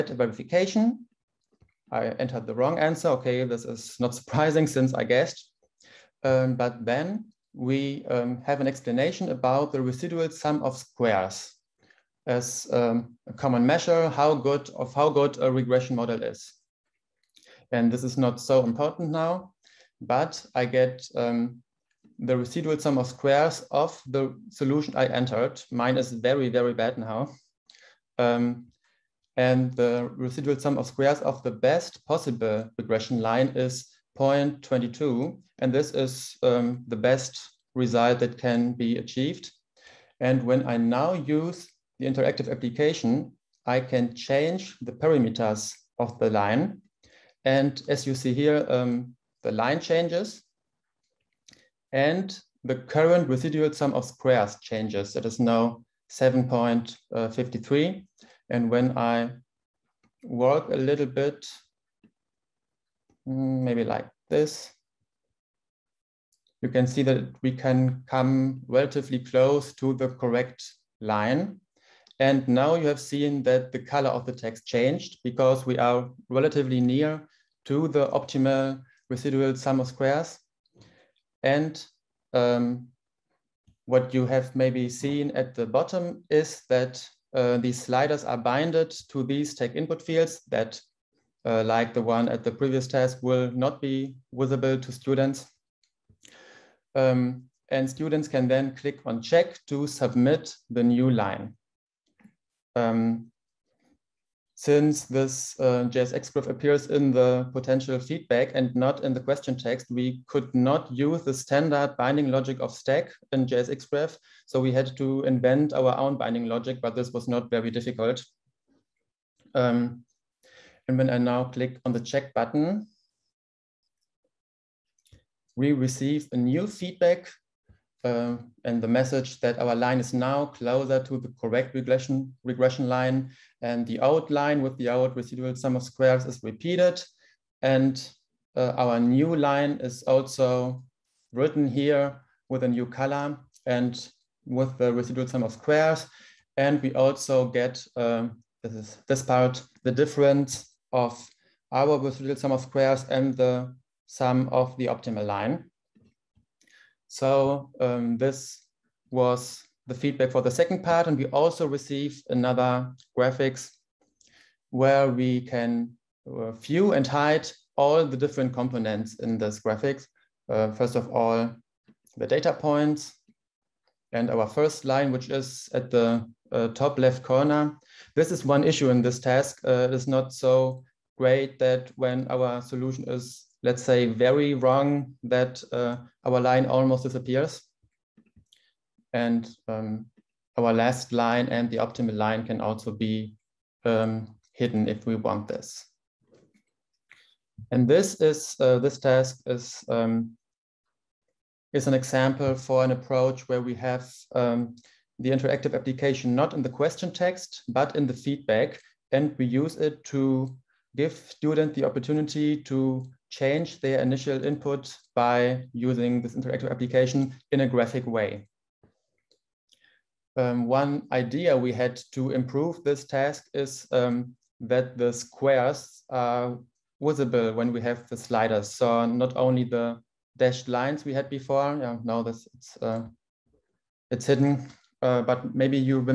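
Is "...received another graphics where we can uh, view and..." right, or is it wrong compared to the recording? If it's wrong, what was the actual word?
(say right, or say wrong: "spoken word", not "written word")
right.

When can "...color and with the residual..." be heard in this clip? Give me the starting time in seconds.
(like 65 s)
142 s.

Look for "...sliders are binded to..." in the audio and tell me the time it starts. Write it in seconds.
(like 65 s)
87 s.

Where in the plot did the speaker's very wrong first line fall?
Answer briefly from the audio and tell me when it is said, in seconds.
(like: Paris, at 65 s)
Top left corner, at 176 s.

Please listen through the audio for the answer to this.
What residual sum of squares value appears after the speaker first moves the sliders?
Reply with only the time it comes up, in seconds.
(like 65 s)
56 s.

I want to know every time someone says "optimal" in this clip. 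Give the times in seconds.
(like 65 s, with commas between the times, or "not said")
78 s, 154 s, 191 s.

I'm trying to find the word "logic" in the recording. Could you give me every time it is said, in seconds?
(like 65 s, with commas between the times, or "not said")
112 s, 116 s.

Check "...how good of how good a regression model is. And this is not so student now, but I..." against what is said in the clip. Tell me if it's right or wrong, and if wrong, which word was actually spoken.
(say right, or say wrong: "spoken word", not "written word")
wrong: "important", not "student".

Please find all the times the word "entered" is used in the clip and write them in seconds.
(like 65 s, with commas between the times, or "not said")
2 s, 25 s.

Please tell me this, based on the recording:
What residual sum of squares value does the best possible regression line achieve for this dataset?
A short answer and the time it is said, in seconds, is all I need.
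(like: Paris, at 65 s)
0.22, at 34 s.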